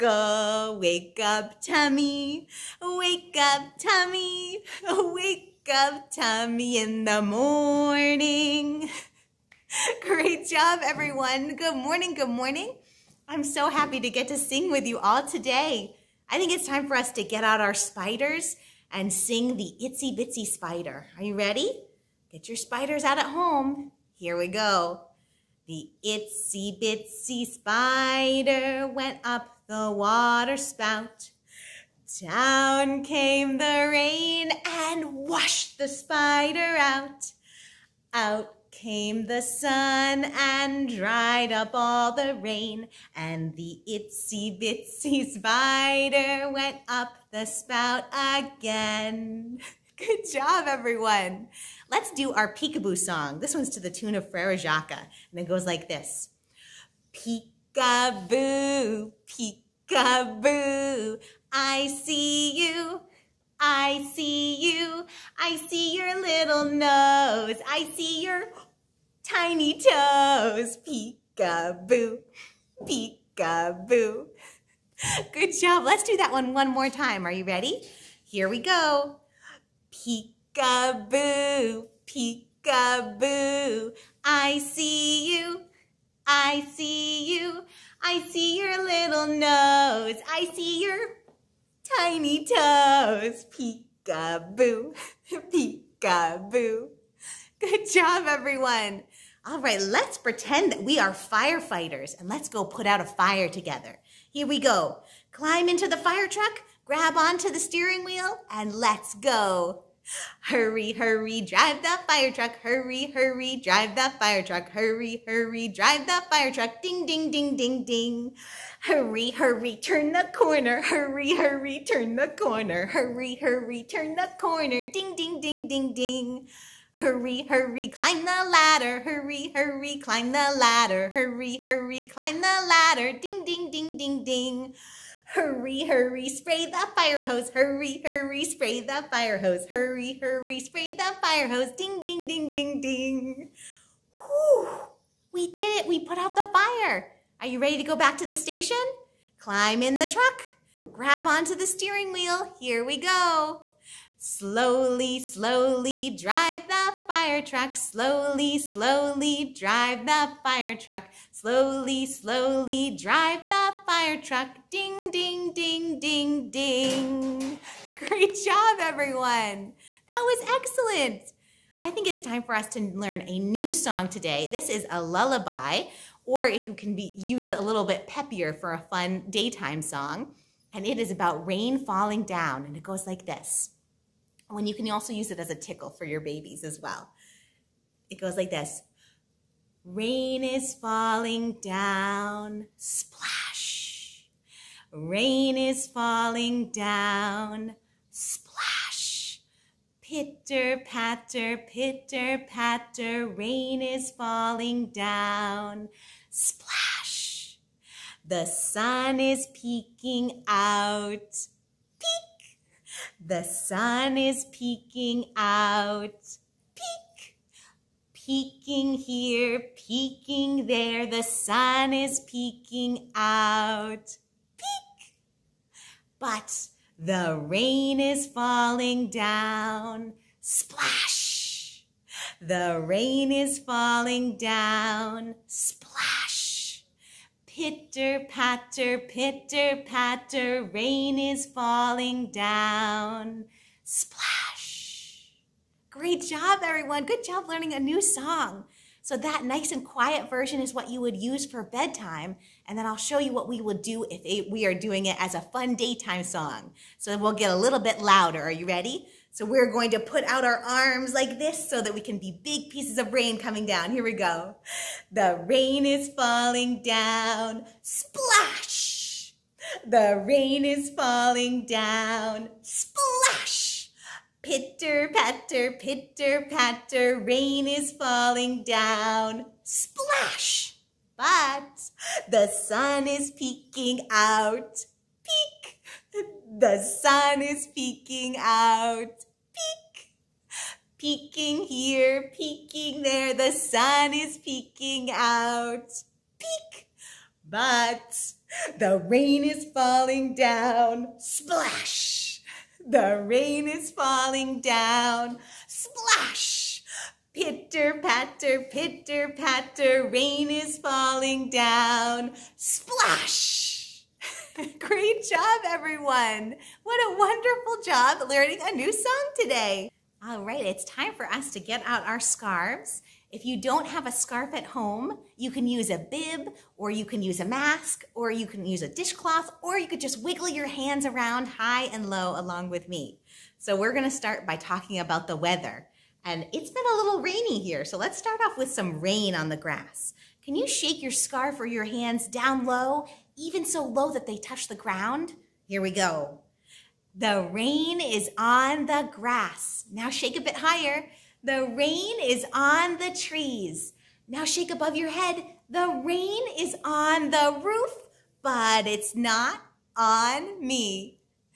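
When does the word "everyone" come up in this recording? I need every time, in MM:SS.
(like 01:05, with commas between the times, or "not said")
00:10, 00:50, 01:38, 02:48, 04:06, 05:15.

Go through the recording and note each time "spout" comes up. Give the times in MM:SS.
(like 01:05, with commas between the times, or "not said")
00:30, 00:47.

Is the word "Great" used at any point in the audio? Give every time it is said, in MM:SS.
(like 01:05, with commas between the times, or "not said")
00:10, 02:48, 04:05, 05:14.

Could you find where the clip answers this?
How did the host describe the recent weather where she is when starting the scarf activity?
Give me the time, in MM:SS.
05:37.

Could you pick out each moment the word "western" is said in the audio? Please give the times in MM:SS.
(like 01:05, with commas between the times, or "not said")
not said.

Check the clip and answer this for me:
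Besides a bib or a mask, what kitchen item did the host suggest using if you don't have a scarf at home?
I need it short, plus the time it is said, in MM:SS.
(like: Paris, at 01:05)
dishcloth, at 05:28.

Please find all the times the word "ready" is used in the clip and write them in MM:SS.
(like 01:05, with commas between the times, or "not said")
00:21, 01:17, 02:27, 04:18.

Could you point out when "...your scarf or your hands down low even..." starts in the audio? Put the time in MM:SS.
05:41.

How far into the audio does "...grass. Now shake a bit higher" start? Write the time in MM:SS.
05:49.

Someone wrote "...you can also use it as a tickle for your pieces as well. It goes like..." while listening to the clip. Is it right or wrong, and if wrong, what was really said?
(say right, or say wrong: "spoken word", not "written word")
wrong: "babies", not "pieces".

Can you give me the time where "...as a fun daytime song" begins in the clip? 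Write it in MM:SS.
04:15.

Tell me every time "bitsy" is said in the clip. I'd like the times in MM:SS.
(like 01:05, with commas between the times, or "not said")
00:20, 00:26, 00:44.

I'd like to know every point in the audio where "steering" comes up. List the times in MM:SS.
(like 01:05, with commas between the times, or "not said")
01:47, 02:31.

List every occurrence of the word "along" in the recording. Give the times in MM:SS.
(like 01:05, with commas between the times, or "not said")
05:32.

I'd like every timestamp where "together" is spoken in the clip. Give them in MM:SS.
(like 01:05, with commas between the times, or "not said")
01:43.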